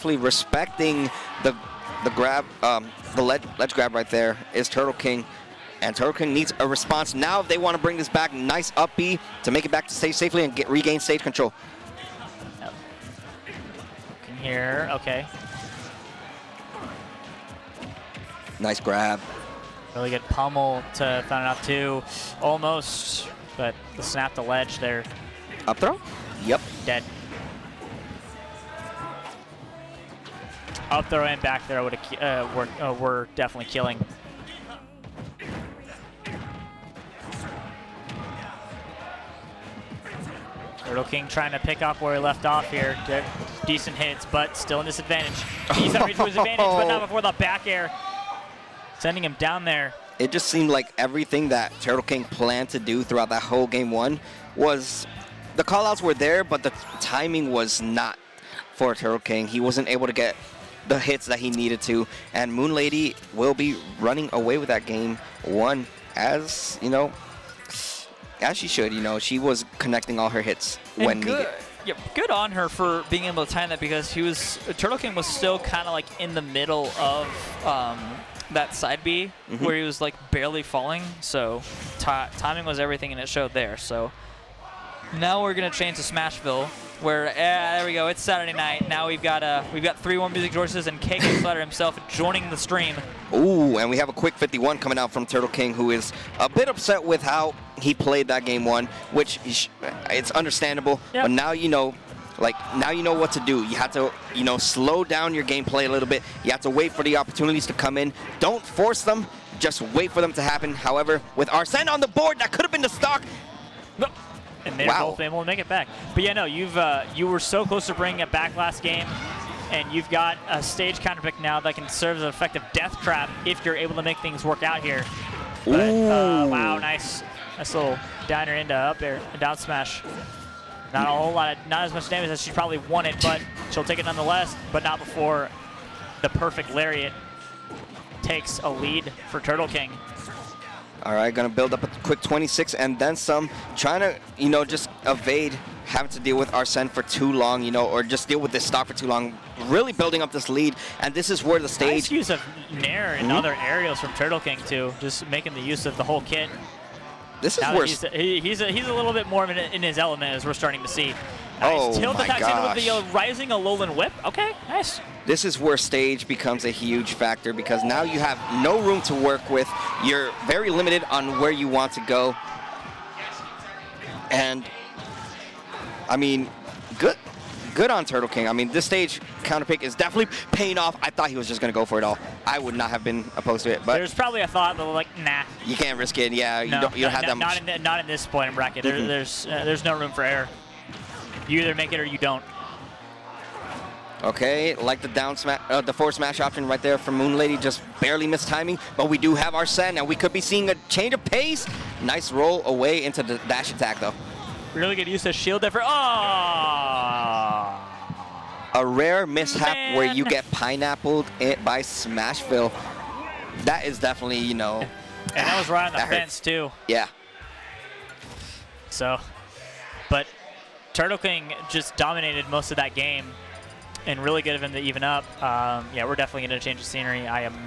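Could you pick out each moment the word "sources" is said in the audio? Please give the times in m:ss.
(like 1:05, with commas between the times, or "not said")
1:30.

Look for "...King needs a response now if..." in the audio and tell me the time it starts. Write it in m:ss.
0:06.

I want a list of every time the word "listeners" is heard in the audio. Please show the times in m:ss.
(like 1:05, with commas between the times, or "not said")
not said.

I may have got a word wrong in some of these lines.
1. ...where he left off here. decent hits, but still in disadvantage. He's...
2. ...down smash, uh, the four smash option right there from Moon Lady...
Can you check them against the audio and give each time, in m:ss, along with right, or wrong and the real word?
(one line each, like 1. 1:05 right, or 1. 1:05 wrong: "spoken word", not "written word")
1. 0:41 right
2. 3:15 right.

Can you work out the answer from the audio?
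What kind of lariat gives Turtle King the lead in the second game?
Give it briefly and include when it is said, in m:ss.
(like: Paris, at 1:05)
perfect lariat, at 2:16.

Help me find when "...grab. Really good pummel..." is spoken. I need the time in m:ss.
0:18.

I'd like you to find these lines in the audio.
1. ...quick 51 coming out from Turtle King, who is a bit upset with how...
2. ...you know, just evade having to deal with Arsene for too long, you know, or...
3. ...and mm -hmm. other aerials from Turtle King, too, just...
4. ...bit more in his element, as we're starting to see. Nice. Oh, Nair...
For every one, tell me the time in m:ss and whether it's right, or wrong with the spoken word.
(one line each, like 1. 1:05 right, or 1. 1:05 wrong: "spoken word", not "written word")
1. 1:34 right
2. 2:24 right
3. 2:33 right
4. 2:39 wrong: "Tilt", not "Nair".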